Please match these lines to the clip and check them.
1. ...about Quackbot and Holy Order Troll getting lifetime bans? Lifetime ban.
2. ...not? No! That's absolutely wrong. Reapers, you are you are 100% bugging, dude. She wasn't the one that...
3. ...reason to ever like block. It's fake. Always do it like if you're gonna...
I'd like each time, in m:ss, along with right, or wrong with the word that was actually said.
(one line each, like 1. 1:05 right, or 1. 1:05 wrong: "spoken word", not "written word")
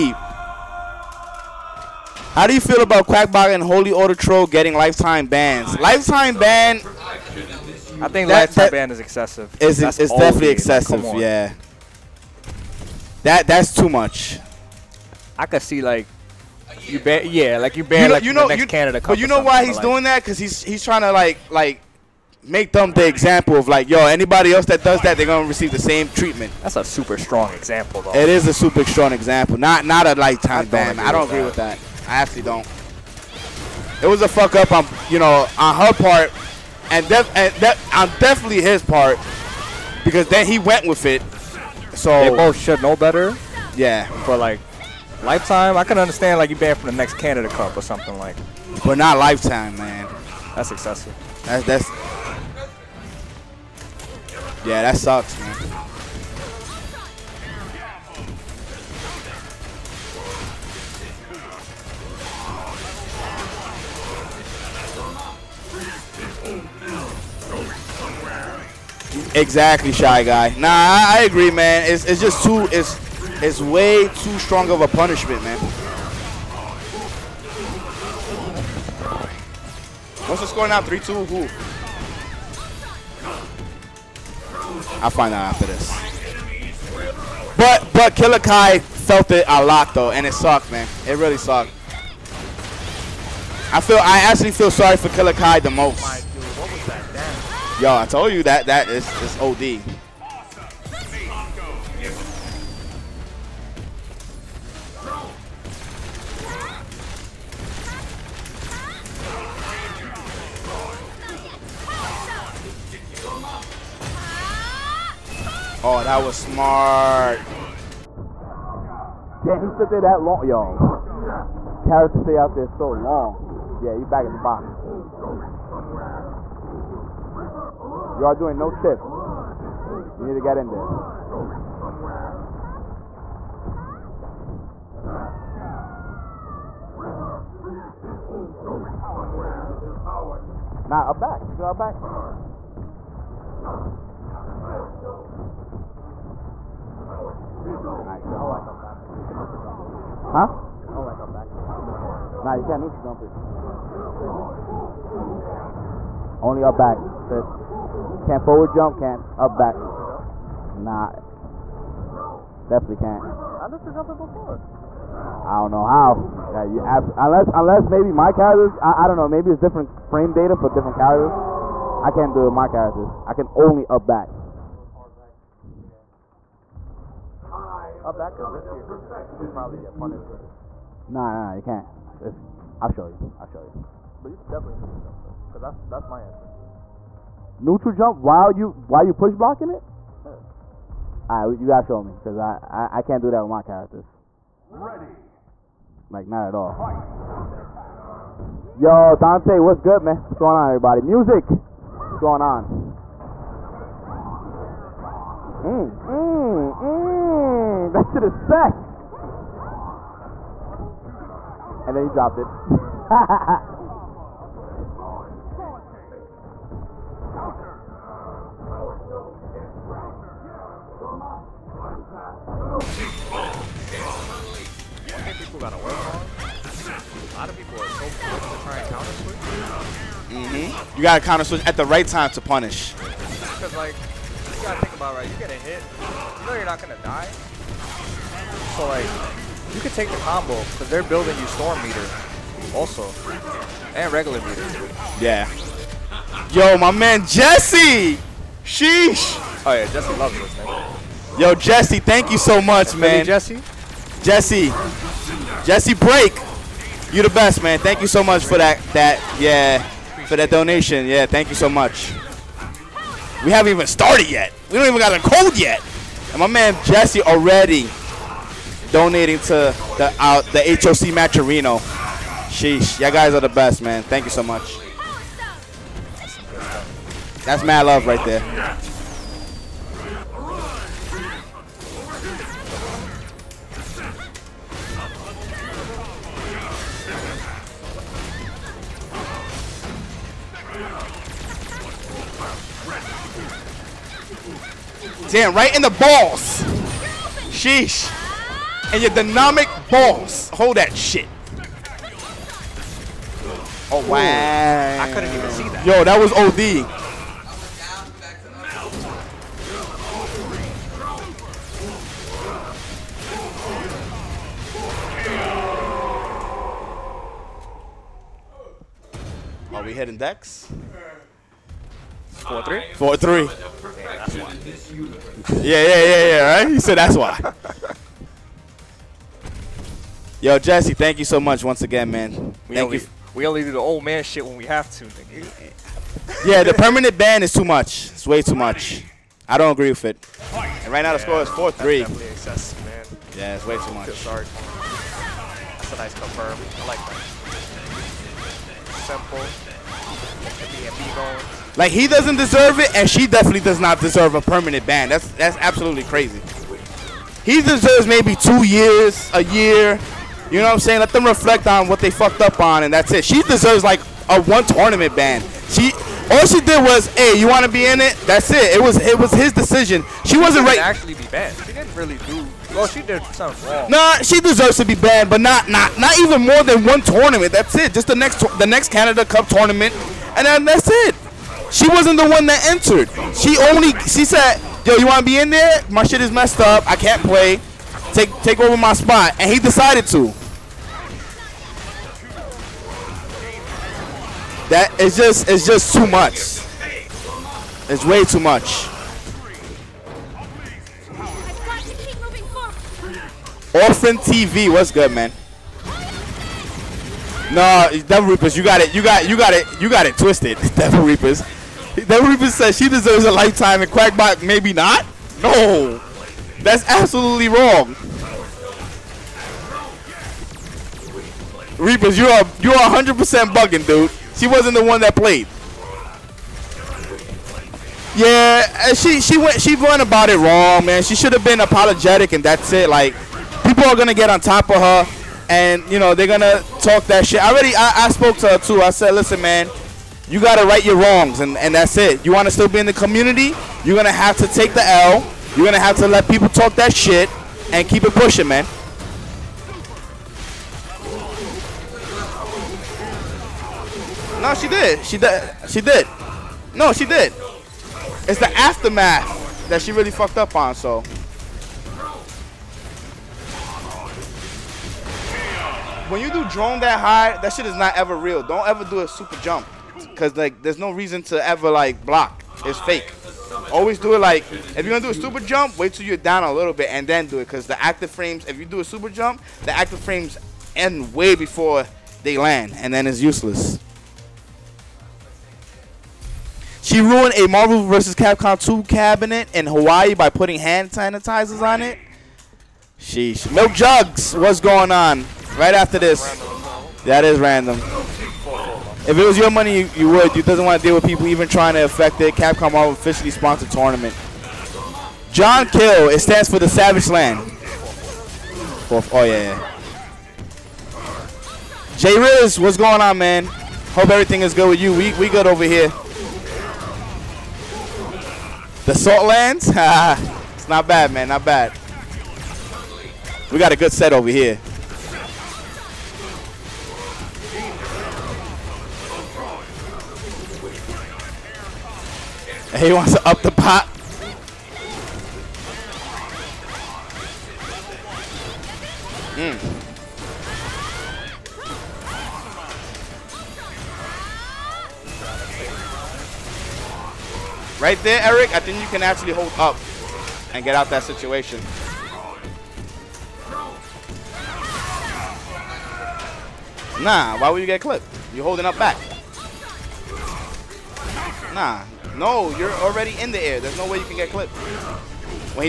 1. 0:02 right
2. 6:54 right
3. 7:50 right.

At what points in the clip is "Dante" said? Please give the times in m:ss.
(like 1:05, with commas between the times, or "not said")
3:19.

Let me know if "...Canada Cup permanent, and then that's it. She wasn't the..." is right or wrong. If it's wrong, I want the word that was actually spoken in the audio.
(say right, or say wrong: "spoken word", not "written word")
wrong: "tournament", not "permanent".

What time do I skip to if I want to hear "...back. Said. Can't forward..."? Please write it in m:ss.
2:36.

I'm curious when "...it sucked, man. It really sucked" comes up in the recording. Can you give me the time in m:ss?
1:30.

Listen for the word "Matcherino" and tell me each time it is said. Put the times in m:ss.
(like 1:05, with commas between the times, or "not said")
4:31.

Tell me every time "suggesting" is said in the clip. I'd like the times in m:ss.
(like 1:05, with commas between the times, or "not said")
not said.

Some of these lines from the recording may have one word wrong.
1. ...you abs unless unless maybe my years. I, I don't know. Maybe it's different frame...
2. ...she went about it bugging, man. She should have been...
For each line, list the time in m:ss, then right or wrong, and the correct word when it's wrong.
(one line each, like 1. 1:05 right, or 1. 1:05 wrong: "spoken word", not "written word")
1. 2:46 wrong: "characters", not "years"
2. 7:09 wrong: "wrong", not "bugging".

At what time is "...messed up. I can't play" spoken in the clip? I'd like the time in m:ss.
6:26.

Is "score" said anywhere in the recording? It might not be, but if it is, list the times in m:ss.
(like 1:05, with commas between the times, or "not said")
1:20, 5:41.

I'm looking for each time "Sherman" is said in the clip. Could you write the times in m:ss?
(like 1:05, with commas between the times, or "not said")
not said.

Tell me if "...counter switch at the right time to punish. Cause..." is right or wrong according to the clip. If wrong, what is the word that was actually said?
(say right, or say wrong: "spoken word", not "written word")
right.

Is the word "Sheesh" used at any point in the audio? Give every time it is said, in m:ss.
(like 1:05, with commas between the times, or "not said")
4:08, 4:32, 4:57, 8:12.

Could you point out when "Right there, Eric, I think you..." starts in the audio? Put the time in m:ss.
9:07.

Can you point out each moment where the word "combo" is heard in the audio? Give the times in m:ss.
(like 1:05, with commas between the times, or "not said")
4:00.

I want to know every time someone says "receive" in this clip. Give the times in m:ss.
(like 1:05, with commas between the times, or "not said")
0:25.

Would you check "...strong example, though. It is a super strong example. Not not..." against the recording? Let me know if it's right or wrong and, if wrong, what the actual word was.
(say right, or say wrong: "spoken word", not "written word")
right.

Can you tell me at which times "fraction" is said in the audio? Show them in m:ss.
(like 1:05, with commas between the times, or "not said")
not said.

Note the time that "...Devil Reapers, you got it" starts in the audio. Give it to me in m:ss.
6:48.